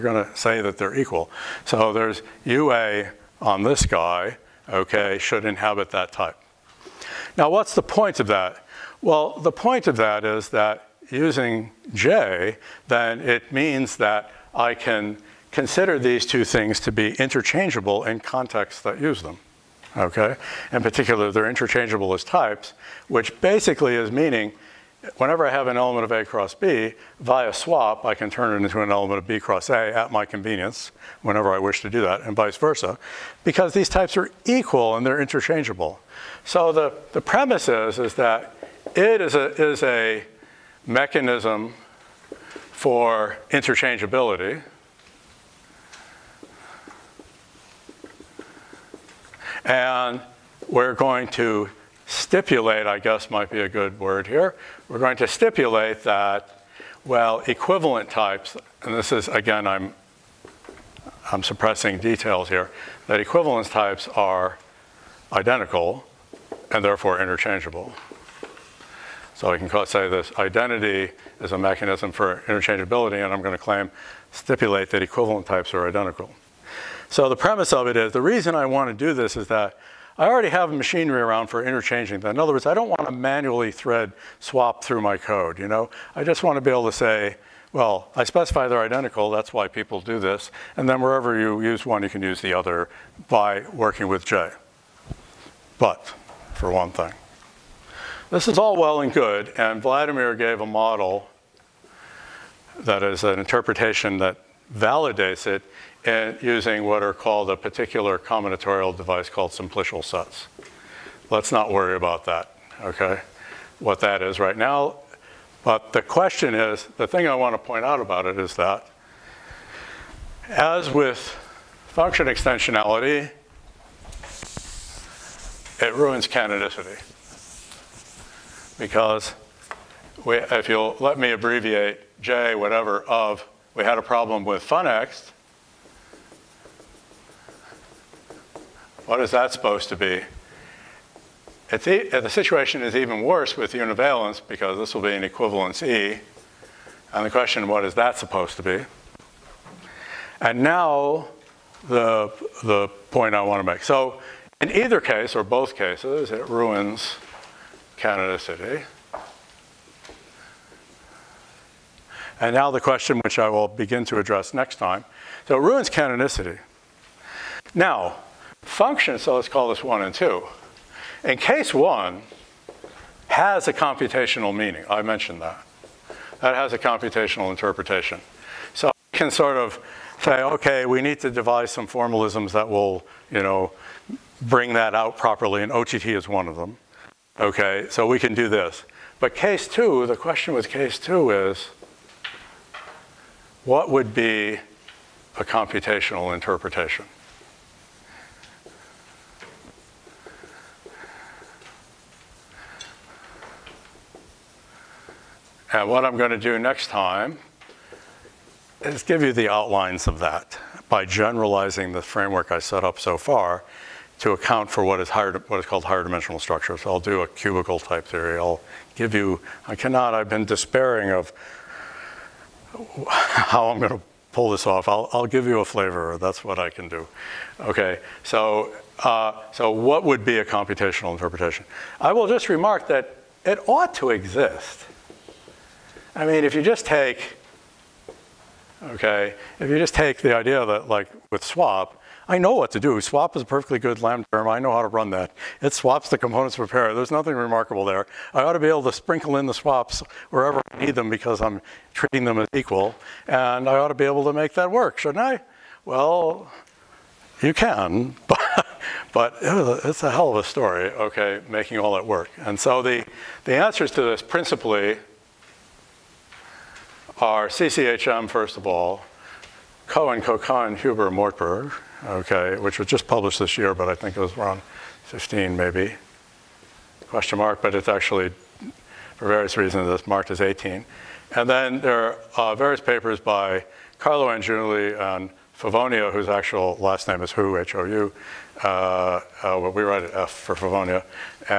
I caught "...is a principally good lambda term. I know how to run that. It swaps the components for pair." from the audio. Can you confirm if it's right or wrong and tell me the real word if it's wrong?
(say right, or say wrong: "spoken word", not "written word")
wrong: "perfectly", not "principally".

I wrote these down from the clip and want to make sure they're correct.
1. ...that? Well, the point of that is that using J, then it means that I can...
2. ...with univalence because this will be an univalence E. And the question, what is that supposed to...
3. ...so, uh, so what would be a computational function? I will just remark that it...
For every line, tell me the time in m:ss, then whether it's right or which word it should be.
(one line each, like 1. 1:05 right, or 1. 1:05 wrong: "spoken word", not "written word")
1. 0:08 right
2. 2:23 wrong: "equivalence", not "univalence"
3. 3:48 wrong: "interpretation", not "function".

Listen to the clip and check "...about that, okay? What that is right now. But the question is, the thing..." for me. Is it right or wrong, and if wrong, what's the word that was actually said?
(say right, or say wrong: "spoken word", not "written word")
right.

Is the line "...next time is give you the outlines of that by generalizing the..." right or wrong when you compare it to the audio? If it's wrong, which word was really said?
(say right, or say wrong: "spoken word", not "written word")
right.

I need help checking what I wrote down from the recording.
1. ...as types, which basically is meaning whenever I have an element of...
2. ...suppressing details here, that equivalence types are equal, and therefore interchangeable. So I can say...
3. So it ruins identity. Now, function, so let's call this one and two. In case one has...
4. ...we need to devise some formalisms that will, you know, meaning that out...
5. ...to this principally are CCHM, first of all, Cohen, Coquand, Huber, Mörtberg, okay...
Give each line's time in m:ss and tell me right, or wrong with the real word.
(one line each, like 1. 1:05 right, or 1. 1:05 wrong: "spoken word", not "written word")
1. 0:22 right
2. 1:01 wrong: "identical", not "equal"
3. 2:45 wrong: "canonicity", not "identity"
4. 3:00 wrong: "bring", not "meaning"
5. 4:23 right.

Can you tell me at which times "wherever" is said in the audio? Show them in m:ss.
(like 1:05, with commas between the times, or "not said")
1:31, 4:10.